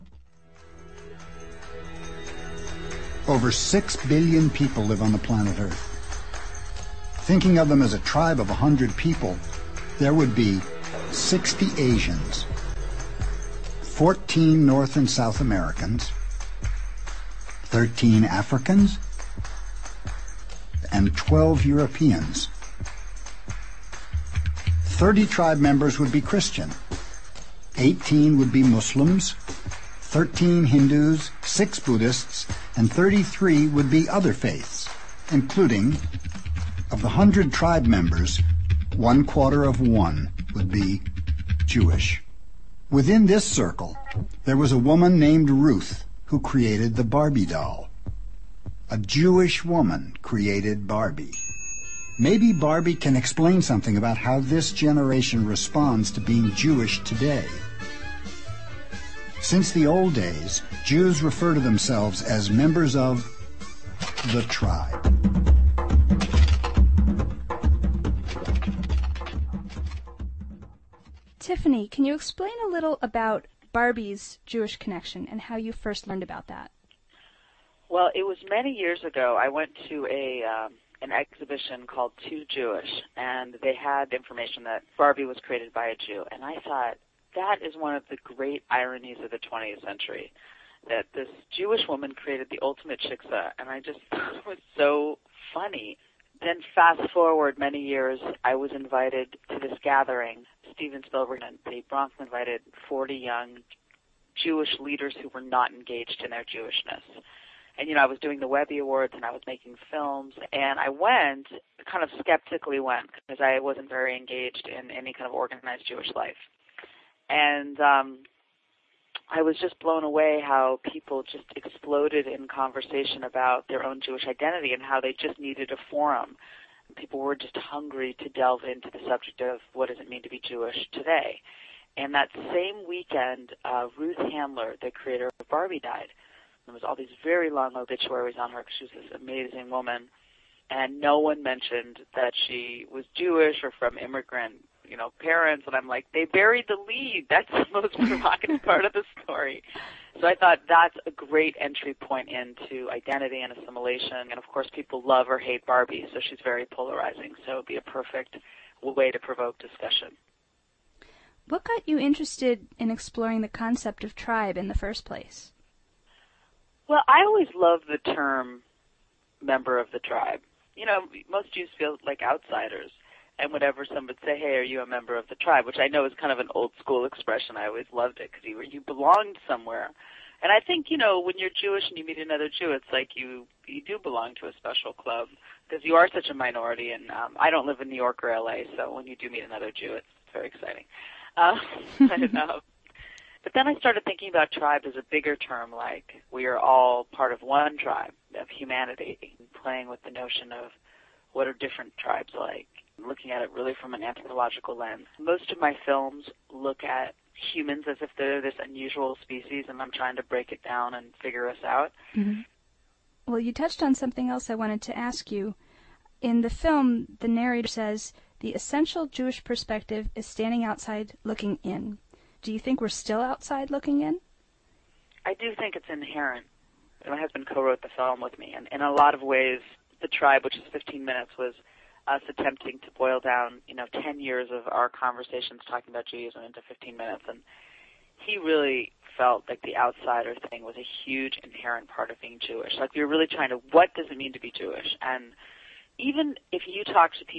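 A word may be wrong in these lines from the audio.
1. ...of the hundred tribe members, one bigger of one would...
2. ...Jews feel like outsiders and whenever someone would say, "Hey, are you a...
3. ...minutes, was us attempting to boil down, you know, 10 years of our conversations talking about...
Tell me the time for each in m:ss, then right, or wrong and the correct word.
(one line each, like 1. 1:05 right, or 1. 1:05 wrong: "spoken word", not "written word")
1. 0:36 wrong: "quarter", not "bigger"
2. 2:51 right
3. 3:51 right.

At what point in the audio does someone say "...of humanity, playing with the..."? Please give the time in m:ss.
3:18.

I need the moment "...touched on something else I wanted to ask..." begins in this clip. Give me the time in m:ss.
3:33.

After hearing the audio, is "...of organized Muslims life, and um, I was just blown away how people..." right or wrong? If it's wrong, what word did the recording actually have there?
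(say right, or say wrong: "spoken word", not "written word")
wrong: "Jewish", not "Muslims".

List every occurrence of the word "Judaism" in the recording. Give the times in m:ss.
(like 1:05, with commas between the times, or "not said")
3:56.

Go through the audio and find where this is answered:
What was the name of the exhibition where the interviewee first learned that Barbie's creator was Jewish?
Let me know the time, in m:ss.
1:22.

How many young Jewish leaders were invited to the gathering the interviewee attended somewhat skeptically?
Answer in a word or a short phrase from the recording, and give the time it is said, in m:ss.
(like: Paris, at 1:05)
40, at 1:42.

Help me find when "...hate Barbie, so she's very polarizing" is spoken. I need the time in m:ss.
2:35.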